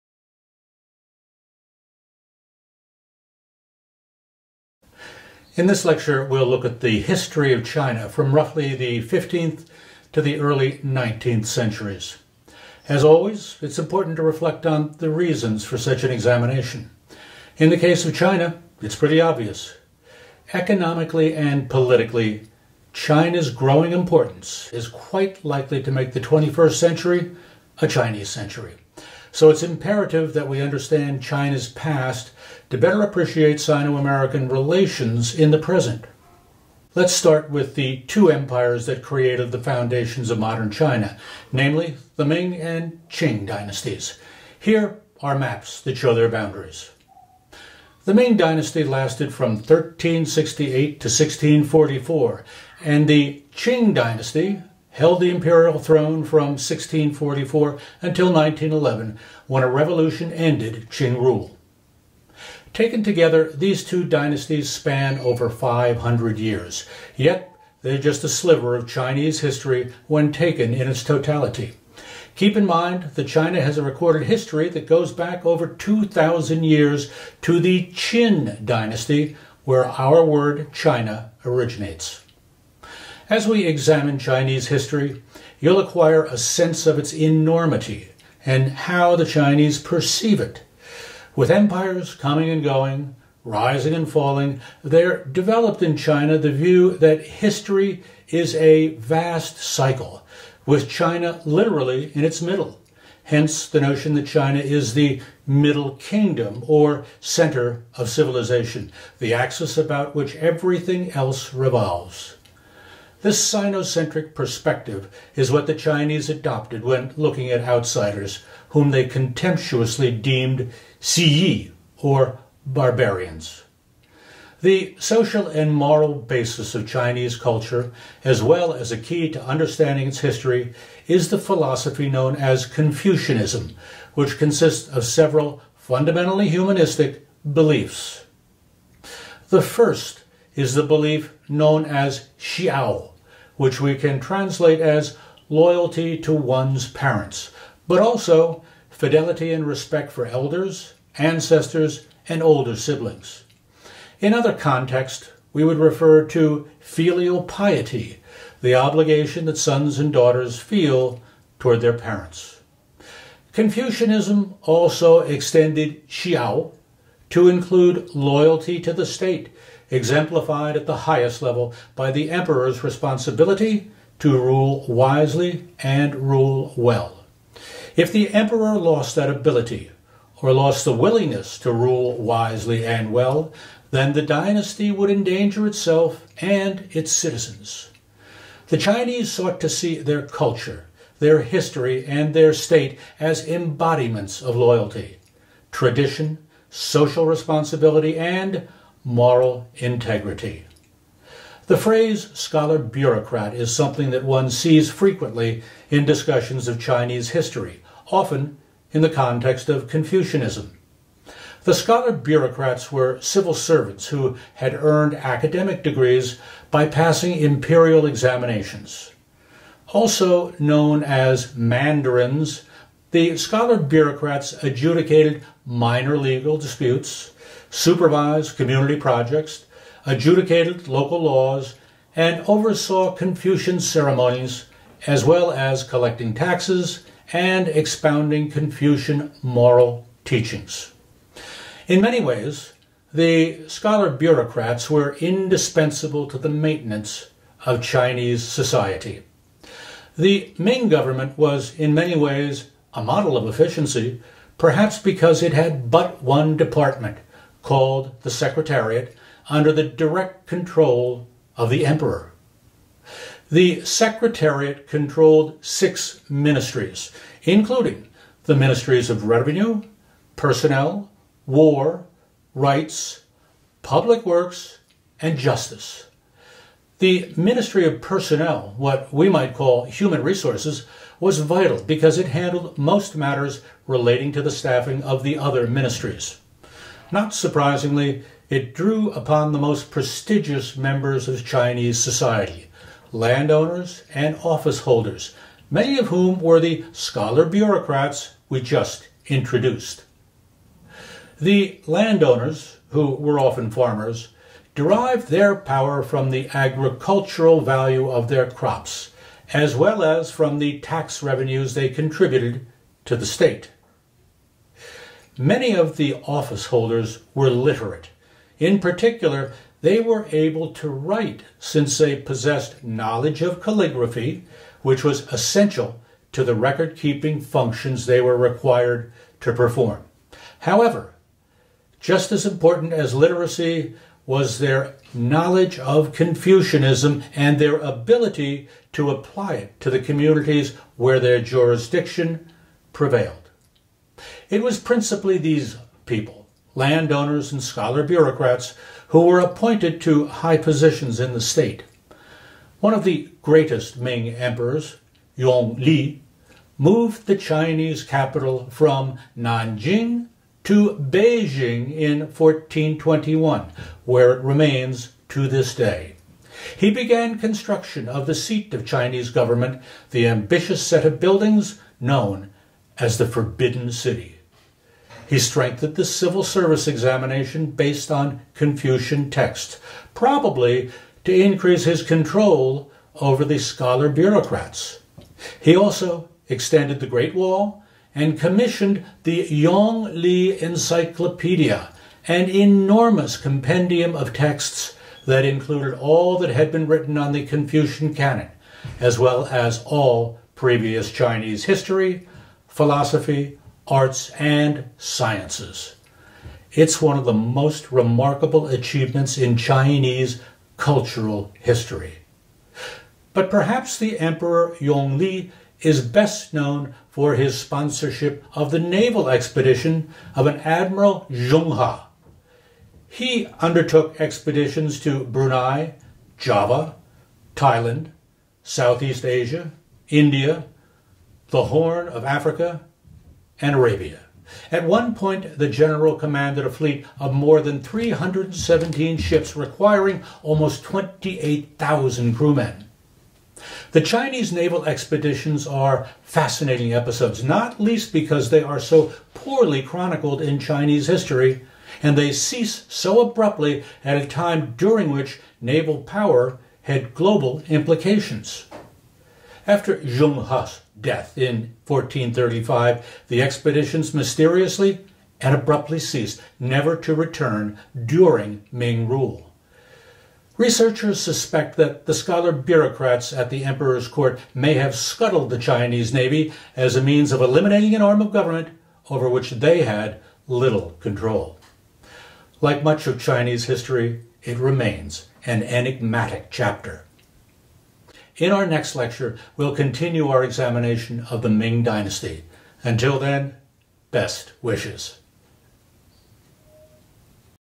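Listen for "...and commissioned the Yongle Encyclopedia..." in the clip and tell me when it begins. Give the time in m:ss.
6:28.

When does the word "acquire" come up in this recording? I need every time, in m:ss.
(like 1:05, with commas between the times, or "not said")
1:25.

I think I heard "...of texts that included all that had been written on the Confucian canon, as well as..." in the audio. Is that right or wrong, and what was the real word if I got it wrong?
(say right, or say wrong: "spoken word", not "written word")
right.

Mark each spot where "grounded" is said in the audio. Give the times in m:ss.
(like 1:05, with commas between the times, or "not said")
not said.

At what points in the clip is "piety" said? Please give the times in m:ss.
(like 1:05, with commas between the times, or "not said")
2:37.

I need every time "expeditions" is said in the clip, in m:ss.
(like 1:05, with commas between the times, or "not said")
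6:59, 7:04, 7:24, 7:43.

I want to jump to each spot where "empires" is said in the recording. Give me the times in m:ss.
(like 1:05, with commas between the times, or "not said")
0:38, 1:31.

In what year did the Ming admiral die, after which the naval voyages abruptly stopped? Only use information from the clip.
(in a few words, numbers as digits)
1435.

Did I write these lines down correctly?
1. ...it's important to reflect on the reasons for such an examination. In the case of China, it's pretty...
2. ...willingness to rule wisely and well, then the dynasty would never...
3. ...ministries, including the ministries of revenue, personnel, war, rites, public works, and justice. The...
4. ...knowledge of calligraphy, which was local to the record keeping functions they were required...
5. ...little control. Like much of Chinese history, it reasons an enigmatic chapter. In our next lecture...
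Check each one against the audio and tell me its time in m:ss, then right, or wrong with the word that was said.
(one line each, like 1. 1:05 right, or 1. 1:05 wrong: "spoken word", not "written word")
1. 0:13 right
2. 3:00 wrong: "endanger", not "never"
3. 4:26 right
4. 5:22 wrong: "essential", not "local"
5. 8:00 wrong: "remains", not "reasons".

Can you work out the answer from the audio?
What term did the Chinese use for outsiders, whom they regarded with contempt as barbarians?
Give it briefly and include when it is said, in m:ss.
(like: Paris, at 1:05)
Siyi, at 2:00.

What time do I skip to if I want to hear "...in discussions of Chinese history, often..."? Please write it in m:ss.
3:25.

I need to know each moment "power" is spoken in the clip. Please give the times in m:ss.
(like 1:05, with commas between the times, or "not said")
5:05, 7:36.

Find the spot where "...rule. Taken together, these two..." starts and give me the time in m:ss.
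1:01.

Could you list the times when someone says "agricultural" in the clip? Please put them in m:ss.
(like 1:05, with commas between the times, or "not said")
5:06.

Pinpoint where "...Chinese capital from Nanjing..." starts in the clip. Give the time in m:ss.
5:57.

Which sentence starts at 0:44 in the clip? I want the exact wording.
Here are maps that show their boundaries.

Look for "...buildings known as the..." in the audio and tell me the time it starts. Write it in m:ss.
6:11.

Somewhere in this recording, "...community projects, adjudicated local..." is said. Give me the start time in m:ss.
3:48.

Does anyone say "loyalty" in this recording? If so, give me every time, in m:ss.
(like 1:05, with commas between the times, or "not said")
2:25, 2:48, 3:14.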